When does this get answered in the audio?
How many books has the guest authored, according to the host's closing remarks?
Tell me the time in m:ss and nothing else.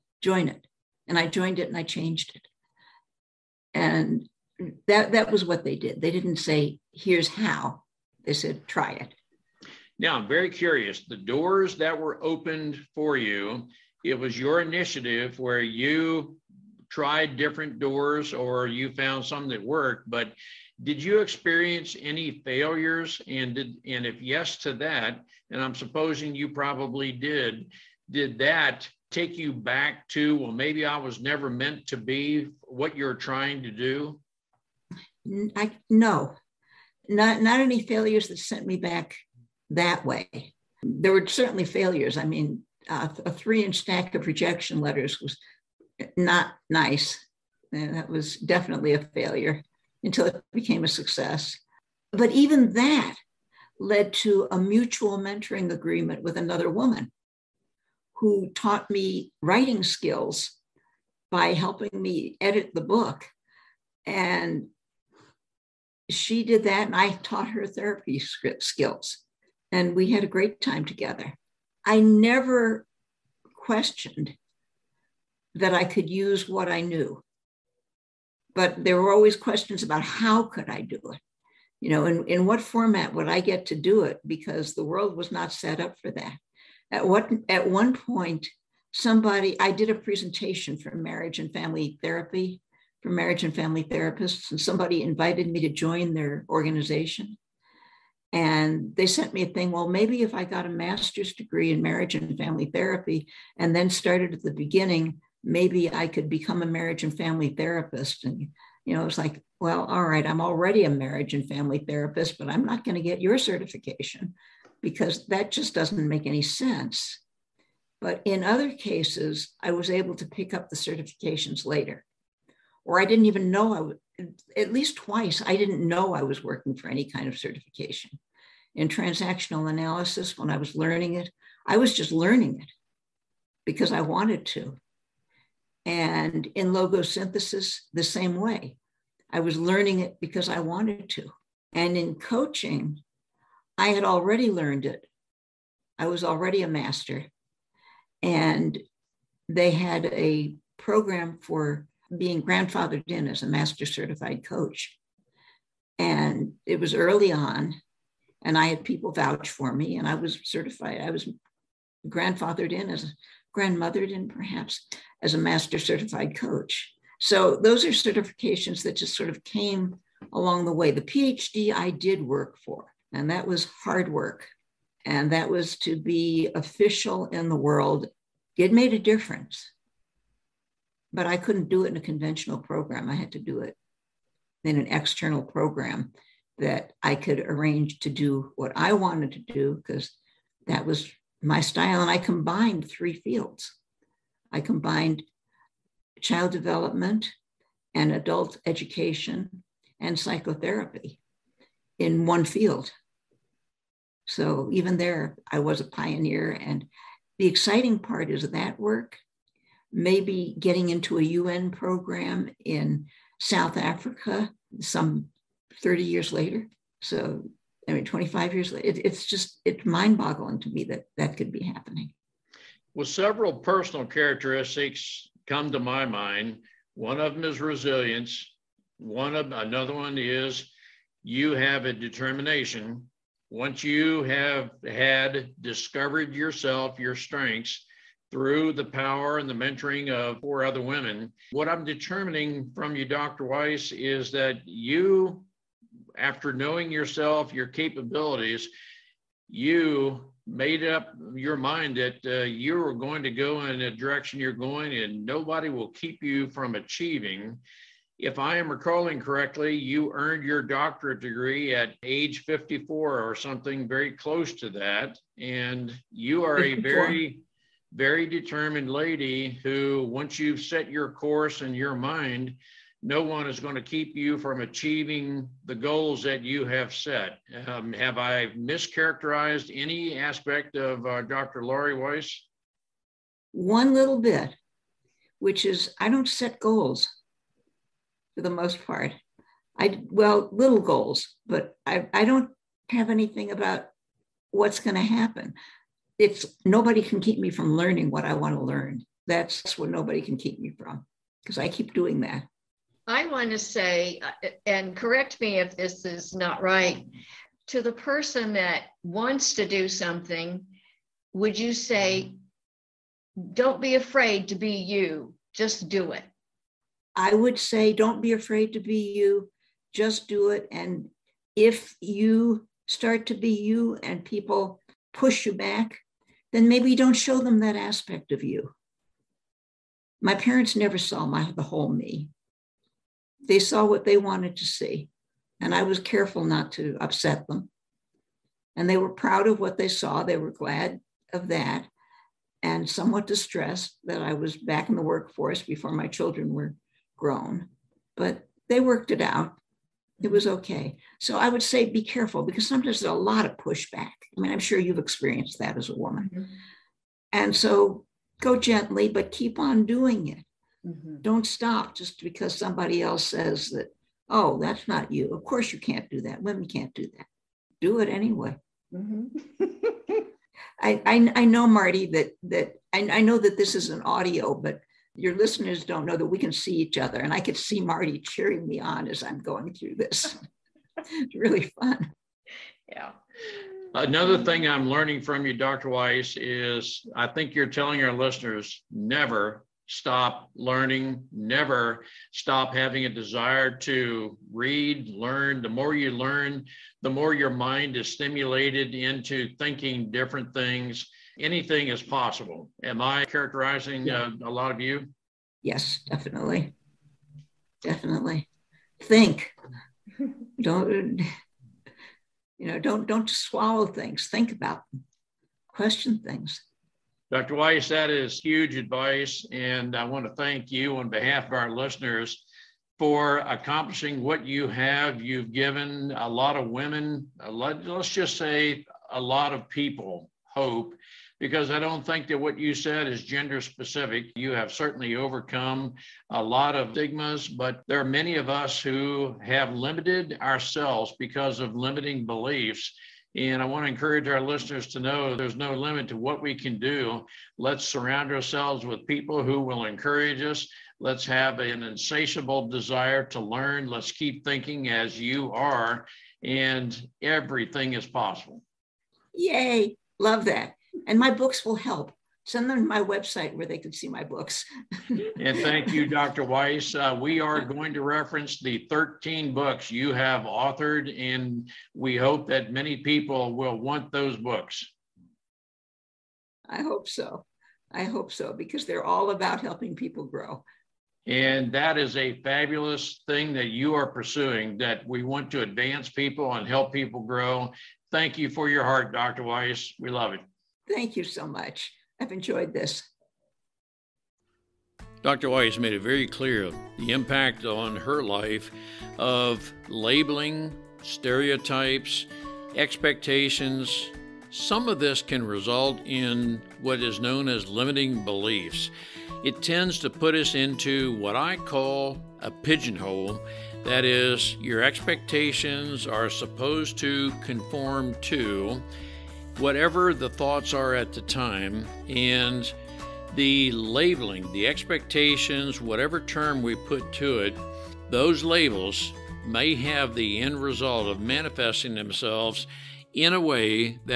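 7:48.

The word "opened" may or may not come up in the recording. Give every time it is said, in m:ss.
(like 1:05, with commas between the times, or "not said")
0:12.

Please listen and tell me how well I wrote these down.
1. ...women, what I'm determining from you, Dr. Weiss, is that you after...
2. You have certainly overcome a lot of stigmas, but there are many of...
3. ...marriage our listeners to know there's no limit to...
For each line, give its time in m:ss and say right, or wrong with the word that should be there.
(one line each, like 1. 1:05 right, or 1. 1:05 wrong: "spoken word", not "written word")
1. 4:00 right
2. 7:14 right
3. 7:23 wrong: "encourage", not "marriage".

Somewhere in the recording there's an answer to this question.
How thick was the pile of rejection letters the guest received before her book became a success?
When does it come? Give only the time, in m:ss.
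0:43.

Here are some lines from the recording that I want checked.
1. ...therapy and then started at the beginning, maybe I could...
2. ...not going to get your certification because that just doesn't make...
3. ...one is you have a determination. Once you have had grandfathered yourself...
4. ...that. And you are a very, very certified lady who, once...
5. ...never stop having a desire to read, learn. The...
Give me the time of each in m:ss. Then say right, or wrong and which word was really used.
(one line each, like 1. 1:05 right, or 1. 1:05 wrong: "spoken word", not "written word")
1. 1:42 right
2. 1:52 right
3. 3:49 wrong: "discovered", not "grandfathered"
4. 4:24 wrong: "determined", not "certified"
5. 6:31 right.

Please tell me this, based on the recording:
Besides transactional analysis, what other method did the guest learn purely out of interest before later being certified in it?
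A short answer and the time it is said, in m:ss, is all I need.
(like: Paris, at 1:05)
logosynthesis, at 2:16.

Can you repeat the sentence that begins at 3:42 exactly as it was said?
Well, several personal characteristics come to my mind.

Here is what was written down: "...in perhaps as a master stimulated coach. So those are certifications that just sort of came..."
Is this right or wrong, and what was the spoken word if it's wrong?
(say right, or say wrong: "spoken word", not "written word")
wrong: "certified", not "stimulated".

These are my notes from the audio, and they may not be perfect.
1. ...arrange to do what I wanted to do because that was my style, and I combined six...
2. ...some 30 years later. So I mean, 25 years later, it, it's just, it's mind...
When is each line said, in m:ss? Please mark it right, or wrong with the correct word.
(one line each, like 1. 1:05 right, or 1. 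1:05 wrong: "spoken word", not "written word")
1. 3:07 wrong: "three", not "six"
2. 3:34 right.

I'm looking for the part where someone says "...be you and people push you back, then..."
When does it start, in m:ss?
5:23.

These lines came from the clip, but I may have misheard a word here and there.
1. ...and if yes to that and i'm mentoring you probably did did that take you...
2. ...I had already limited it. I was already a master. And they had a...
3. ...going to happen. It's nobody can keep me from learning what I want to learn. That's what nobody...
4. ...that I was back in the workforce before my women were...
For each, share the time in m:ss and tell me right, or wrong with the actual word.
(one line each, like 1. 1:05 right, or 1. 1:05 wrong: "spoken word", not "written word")
1. 0:23 wrong: "supposing", not "mentoring"
2. 2:23 wrong: "learned", not "limited"
3. 4:54 right
4. 5:44 wrong: "children", not "women".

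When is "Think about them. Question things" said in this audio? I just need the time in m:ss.
6:54.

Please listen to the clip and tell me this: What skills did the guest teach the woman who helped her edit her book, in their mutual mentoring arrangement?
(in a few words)
therapy script skills.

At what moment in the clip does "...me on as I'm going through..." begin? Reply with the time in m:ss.
6:18.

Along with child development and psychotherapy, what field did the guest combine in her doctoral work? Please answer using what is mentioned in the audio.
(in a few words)
adult education.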